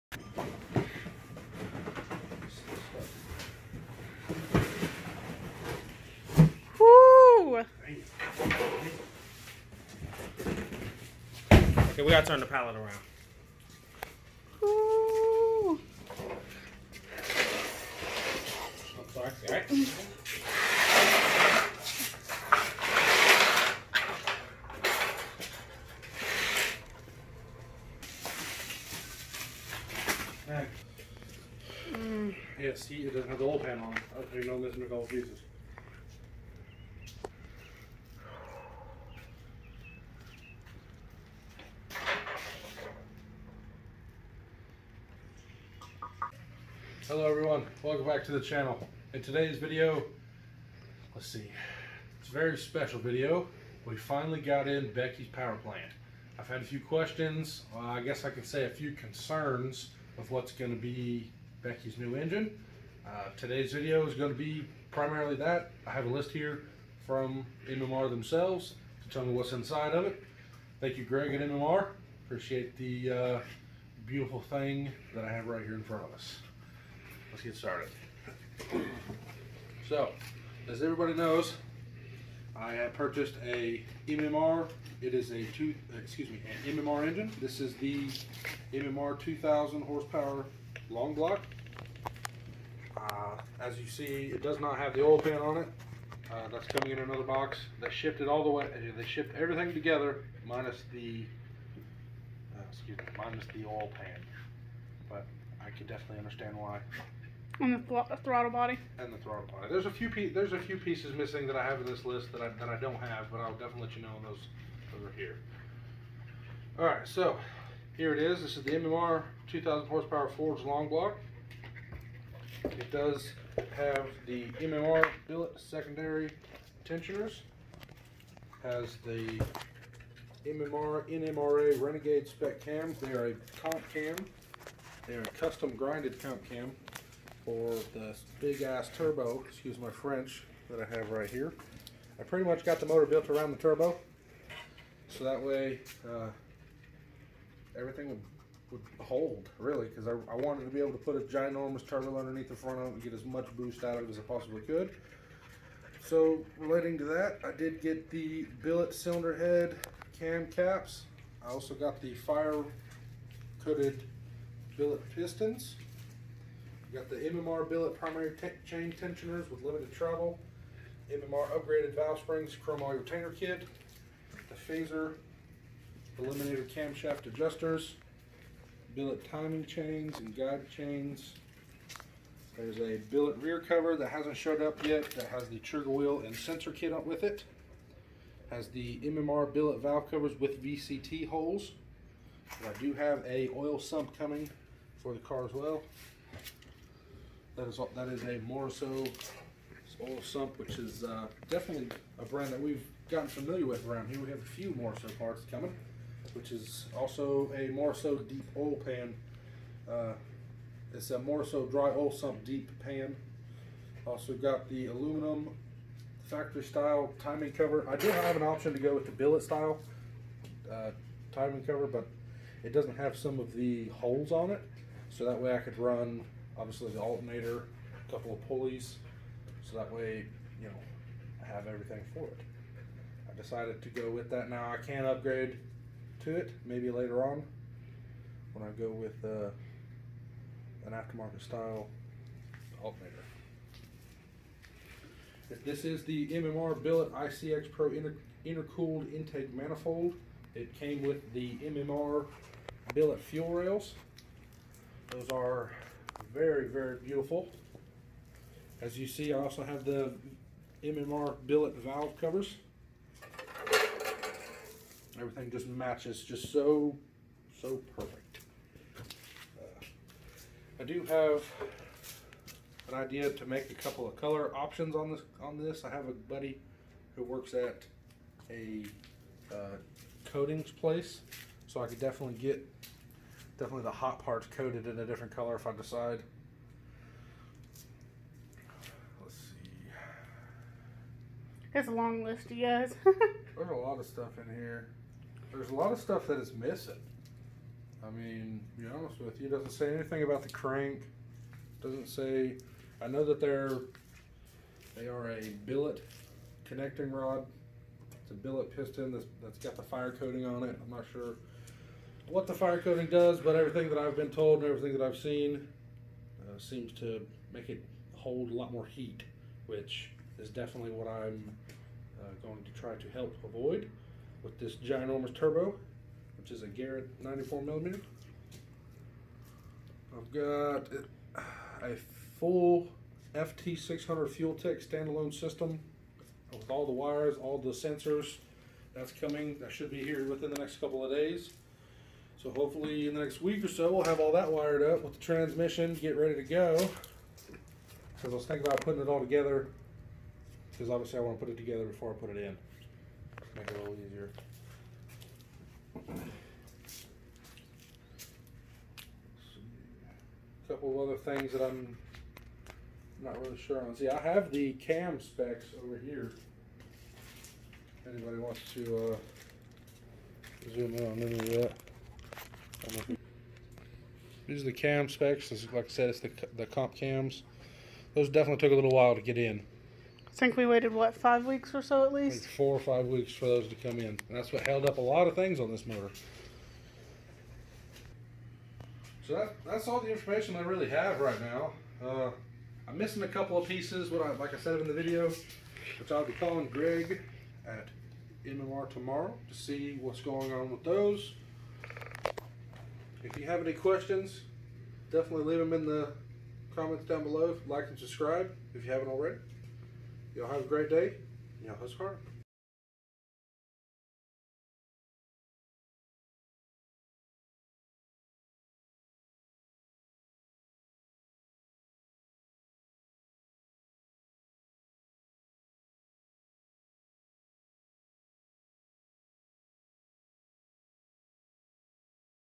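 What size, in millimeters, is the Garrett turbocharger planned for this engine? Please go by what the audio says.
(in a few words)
94 millimeter.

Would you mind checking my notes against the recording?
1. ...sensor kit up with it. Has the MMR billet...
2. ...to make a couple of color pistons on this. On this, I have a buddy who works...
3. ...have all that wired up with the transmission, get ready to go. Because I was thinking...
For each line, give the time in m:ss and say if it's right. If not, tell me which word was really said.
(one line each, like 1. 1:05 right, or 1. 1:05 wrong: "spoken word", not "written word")
1. 3:06 right
2. 4:33 wrong: "options", not "pistons"
3. 5:44 right.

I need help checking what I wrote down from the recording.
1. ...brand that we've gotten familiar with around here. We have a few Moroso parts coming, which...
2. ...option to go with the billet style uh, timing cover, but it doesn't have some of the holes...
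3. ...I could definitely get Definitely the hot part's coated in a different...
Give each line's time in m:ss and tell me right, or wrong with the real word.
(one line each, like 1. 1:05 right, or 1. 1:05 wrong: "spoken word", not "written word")
1. 3:22 right
2. 3:38 right
3. 4:41 right.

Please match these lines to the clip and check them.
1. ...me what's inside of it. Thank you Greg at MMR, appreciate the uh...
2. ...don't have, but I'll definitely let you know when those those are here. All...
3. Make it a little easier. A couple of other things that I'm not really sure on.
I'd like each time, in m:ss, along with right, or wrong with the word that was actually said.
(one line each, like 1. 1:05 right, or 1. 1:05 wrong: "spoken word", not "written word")
1. 1:09 right
2. 1:52 right
3. 5:53 right.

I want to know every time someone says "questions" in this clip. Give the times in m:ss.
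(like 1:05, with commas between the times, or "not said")
0:56, 6:43.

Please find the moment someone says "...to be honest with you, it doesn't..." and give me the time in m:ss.
4:58.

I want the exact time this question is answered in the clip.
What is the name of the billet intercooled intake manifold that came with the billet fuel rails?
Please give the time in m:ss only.
4:07.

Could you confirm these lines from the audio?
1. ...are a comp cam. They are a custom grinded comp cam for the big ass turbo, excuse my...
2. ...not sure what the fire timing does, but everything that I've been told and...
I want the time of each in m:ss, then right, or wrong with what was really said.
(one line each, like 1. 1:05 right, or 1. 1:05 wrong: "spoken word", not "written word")
1. 2:13 right
2. 5:10 wrong: "coating", not "timing".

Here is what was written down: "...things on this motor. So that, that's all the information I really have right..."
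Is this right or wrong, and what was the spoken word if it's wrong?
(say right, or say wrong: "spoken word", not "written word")
right.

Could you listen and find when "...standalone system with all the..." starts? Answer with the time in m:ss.
5:34.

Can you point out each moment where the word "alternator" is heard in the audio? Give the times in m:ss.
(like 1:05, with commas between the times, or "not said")
3:46, 4:02.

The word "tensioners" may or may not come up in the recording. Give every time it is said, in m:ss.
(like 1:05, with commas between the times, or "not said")
2:06, 2:48.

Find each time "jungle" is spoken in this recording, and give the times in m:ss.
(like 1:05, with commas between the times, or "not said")
not said.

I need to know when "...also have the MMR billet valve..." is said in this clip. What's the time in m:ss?
4:19.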